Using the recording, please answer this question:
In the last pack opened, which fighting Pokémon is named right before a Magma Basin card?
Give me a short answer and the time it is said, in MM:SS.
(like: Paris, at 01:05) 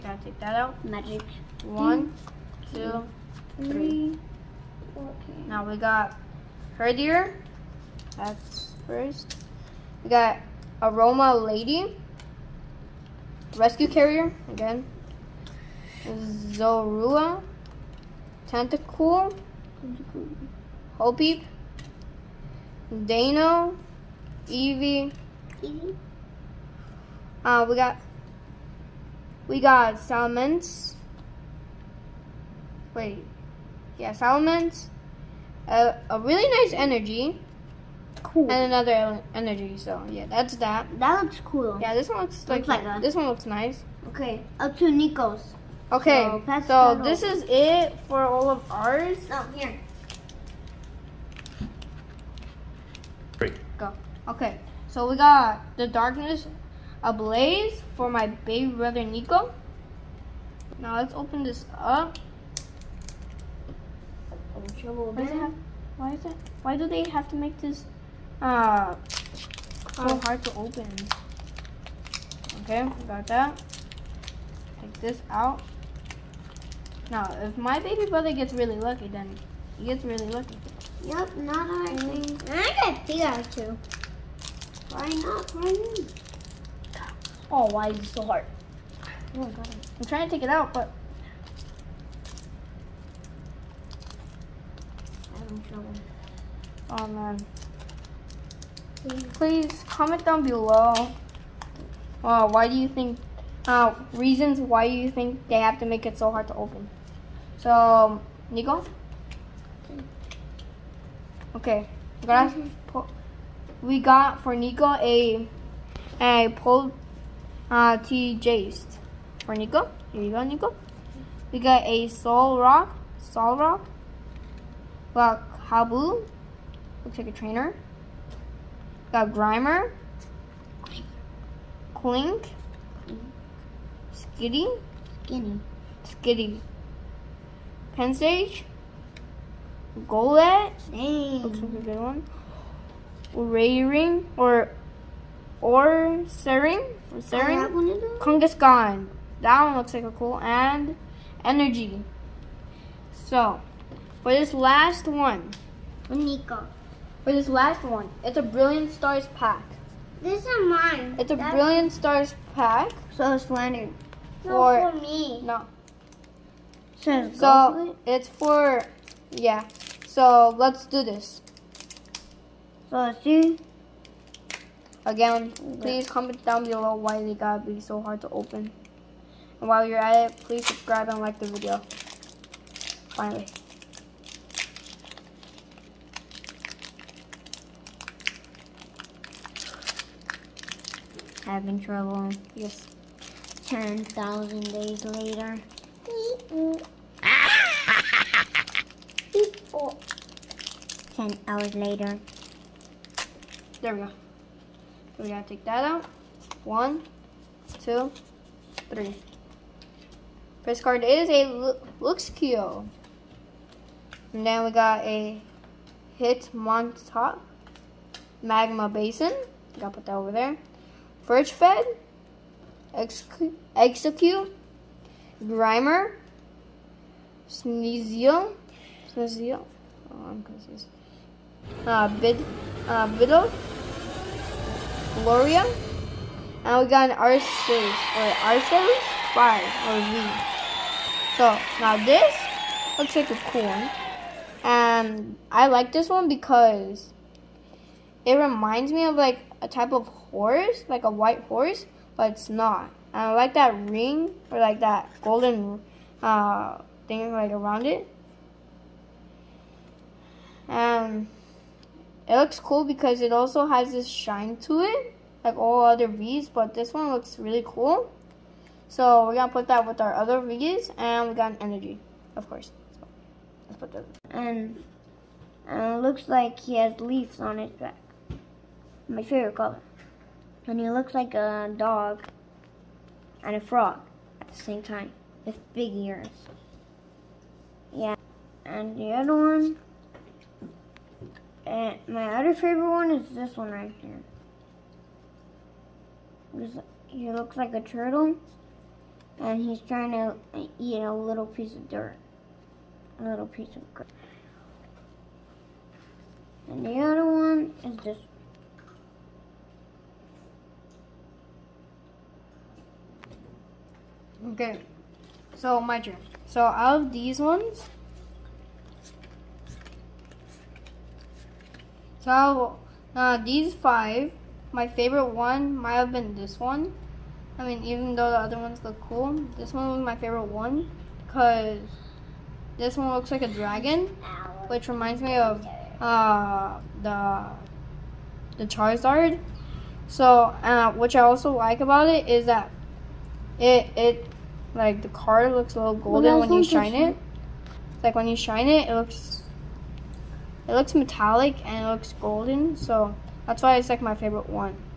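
Hitmontop, at 03:36.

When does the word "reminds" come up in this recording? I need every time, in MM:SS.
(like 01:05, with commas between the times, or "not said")
04:08, 05:34.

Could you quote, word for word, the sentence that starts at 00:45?
Okay, so, so this is it for all of ours.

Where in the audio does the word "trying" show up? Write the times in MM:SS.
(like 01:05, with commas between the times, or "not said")
01:30, 04:59.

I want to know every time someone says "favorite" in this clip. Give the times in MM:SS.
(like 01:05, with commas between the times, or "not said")
04:39, 04:52, 05:24, 05:30, 05:54.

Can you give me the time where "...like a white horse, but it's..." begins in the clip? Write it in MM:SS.
04:10.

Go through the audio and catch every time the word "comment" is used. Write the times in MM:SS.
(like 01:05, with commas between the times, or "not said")
01:39, 02:56.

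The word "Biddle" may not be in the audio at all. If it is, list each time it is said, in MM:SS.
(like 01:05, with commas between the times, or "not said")
03:53.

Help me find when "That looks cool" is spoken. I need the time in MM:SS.
00:40.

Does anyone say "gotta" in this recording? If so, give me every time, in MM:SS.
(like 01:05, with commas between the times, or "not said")
02:57, 03:39.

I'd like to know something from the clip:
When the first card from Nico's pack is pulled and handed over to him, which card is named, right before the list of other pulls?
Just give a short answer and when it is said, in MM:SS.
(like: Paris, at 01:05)
T Jace, at 01:58.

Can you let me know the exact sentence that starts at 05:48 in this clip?
Like when you shine it, it looks it looks metallic and it looks golden.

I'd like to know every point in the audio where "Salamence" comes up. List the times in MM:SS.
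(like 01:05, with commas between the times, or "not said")
00:29, 00:34.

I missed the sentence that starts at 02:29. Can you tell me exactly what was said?
That one looks like a cool and energy.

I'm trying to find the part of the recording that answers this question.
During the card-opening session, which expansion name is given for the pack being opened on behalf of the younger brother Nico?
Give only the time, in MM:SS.
00:55.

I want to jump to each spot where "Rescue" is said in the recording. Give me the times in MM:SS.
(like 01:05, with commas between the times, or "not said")
00:13.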